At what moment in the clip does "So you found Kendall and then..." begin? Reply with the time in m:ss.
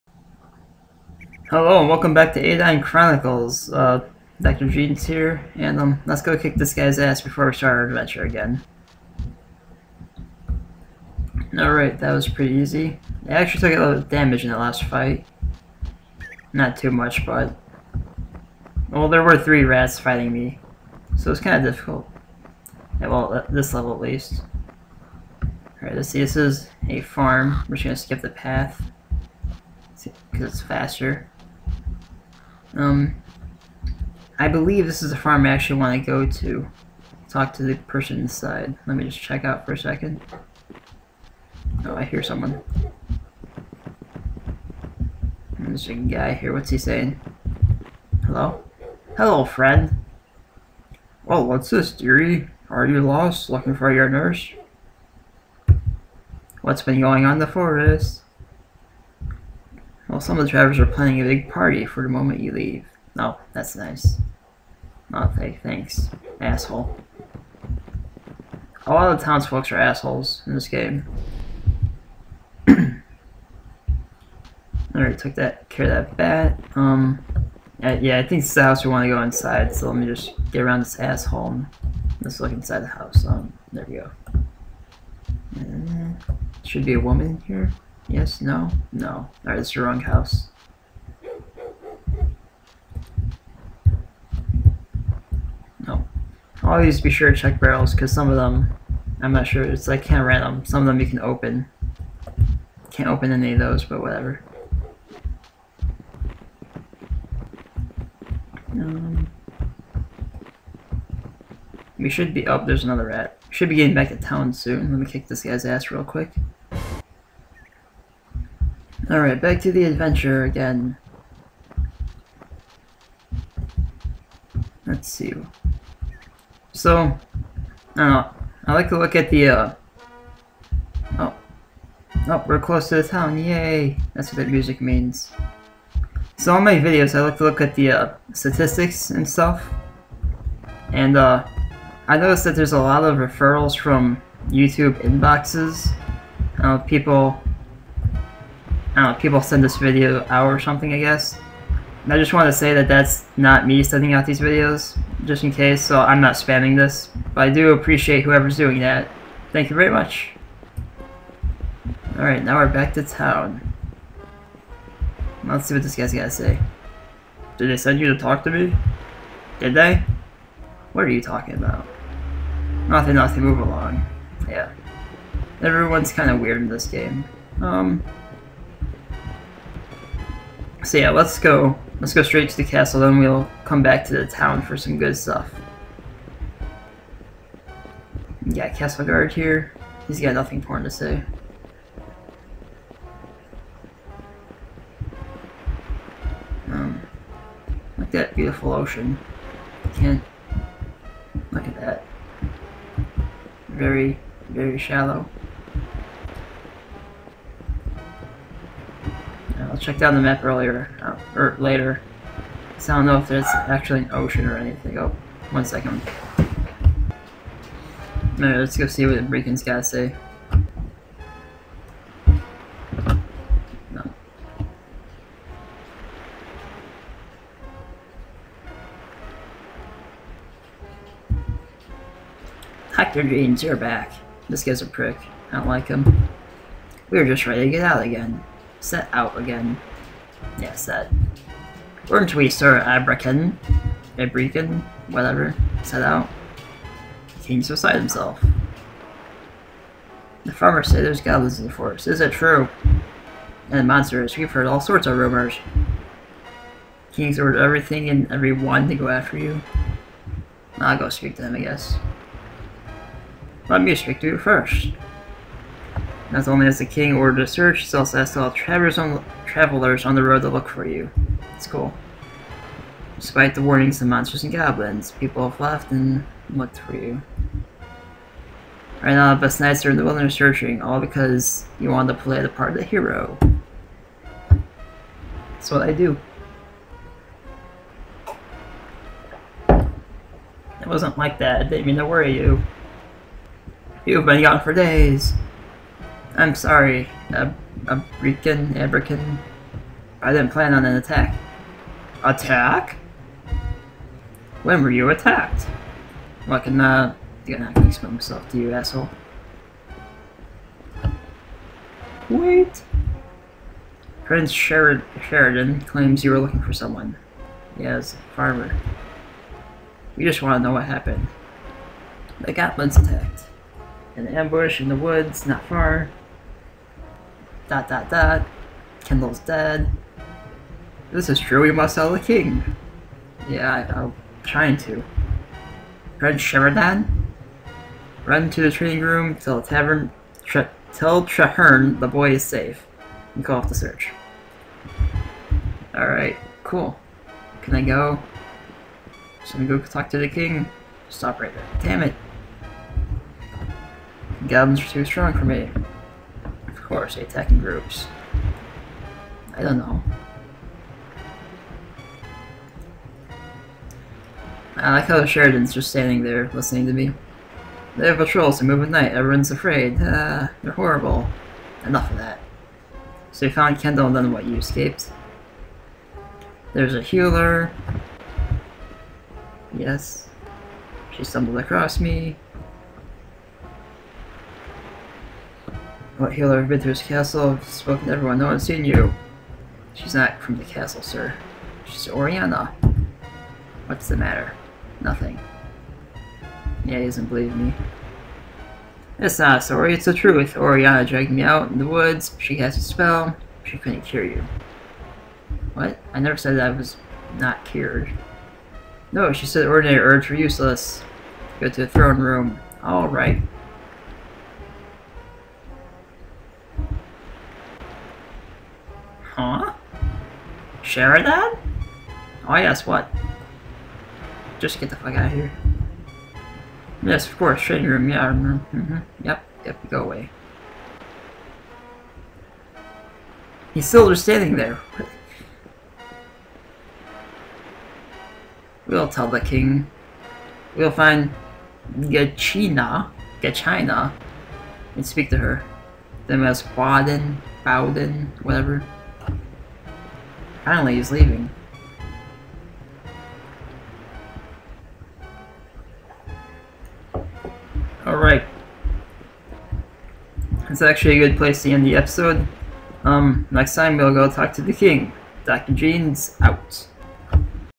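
6:13.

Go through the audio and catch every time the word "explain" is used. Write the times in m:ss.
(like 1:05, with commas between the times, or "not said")
5:07.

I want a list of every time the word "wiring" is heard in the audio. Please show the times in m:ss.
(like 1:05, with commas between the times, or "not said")
not said.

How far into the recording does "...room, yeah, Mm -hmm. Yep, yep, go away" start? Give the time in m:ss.
7:07.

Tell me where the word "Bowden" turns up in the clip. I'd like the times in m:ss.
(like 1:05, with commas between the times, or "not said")
7:27.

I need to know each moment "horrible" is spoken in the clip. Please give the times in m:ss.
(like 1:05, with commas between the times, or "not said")
6:10.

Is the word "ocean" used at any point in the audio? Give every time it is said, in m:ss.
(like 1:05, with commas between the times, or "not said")
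3:18, 3:34.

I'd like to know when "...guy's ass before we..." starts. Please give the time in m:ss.
0:06.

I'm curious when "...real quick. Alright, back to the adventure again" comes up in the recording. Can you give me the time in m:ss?
1:55.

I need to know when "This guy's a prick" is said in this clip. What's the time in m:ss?
3:54.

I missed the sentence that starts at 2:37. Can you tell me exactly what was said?
But I do appreciate whoever's doing that.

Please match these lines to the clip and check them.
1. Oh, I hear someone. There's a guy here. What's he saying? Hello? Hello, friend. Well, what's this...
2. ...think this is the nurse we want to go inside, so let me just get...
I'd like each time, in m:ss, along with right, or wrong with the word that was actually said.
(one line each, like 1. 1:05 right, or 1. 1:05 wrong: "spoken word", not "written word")
1. 0:41 right
2. 1:18 wrong: "house", not "nurse".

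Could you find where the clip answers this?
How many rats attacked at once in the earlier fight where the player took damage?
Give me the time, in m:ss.
0:19.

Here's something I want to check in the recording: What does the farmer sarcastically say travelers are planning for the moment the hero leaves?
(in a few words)
A big party.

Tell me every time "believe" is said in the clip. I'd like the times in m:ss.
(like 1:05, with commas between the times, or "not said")
0:34, 6:37.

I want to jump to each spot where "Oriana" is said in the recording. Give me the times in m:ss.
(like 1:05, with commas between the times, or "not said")
6:32, 6:40.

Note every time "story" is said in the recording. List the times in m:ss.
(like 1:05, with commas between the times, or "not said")
6:39.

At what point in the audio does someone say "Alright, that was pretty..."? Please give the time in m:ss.
0:11.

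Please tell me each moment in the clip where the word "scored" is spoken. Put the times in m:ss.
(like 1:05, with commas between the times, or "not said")
not said.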